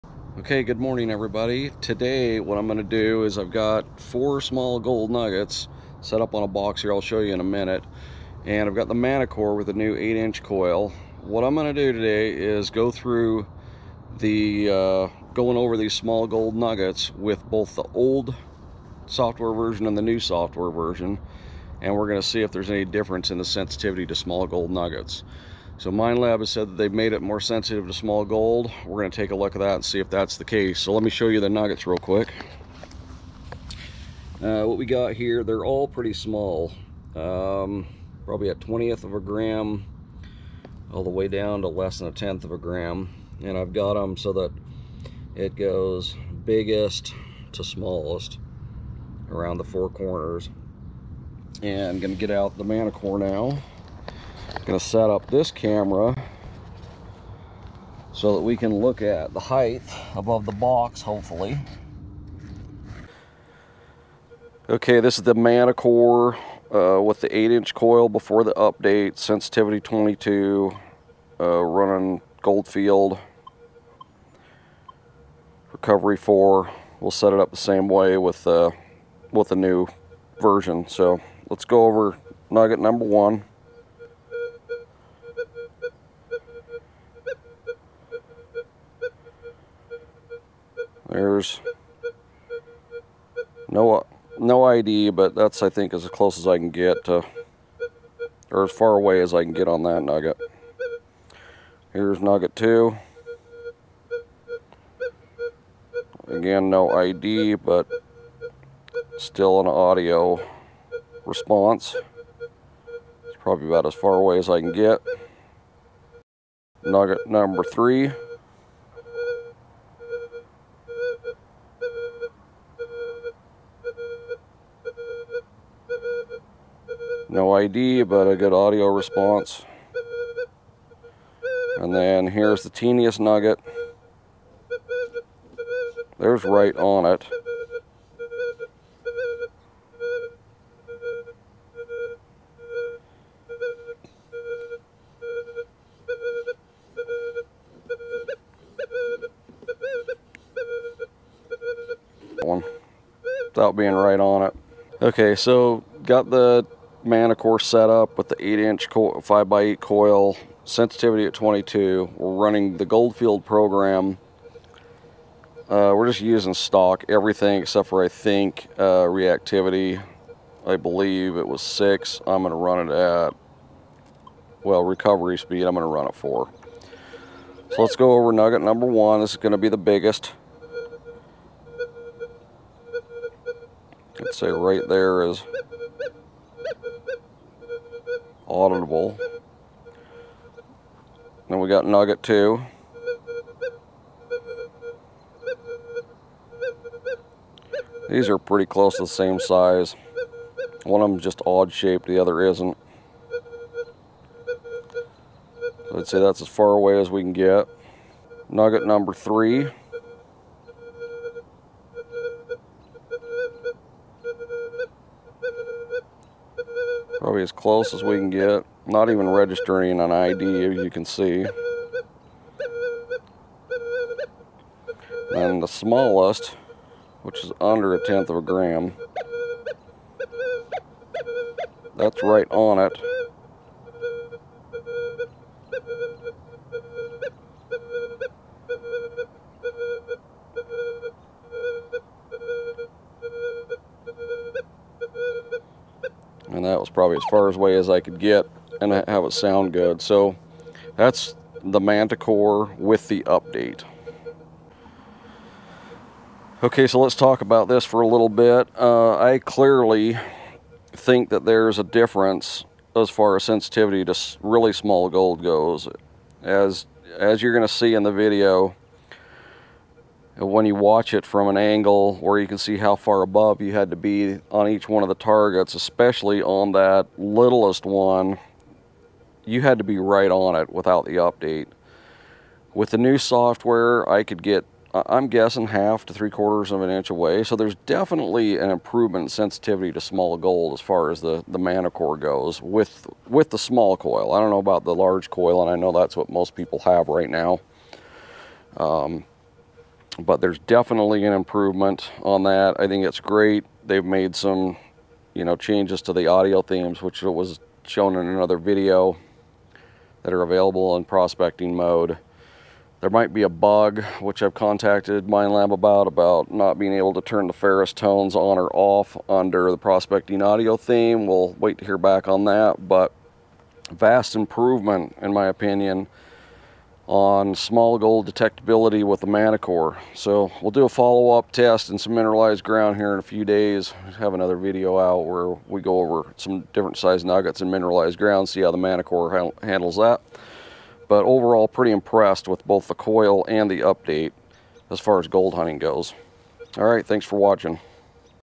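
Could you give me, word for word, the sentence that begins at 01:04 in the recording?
Okay, this is the Manticore uh, with the 8 inch coil before the update, sensitivity 22, uh, running Goldfield, recovery 4.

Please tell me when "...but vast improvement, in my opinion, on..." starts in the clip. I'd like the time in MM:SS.
05:22.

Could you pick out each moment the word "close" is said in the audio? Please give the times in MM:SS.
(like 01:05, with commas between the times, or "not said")
01:36, 03:18, 03:37.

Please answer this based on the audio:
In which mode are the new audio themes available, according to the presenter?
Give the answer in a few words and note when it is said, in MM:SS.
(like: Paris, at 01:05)
prospecting mode, at 05:11.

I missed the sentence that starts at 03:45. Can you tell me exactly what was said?
And the smallest, which is under a tenth of a gram.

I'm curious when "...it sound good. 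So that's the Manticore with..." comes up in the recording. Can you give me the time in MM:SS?
04:09.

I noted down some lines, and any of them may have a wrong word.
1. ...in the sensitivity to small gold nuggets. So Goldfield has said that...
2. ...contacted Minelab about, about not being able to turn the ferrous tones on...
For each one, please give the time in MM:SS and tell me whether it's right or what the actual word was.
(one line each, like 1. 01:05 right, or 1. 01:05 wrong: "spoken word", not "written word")
1. 00:23 wrong: "Minelab", not "Goldfield"
2. 05:14 right.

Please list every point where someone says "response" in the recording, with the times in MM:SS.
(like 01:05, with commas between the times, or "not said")
01:51, 02:08.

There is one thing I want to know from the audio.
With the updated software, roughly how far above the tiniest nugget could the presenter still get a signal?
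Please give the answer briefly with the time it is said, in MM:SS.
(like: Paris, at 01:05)
half to three quarters of an inch, at 04:45.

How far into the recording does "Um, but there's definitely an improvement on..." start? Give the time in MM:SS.
04:58.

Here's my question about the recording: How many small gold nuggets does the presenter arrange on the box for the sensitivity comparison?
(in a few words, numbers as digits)
4.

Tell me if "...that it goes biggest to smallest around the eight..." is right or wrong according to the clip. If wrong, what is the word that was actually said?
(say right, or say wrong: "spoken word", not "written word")
wrong: "four", not "eight".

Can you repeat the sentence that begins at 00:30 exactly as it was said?
So let me show you the nuggets real quick.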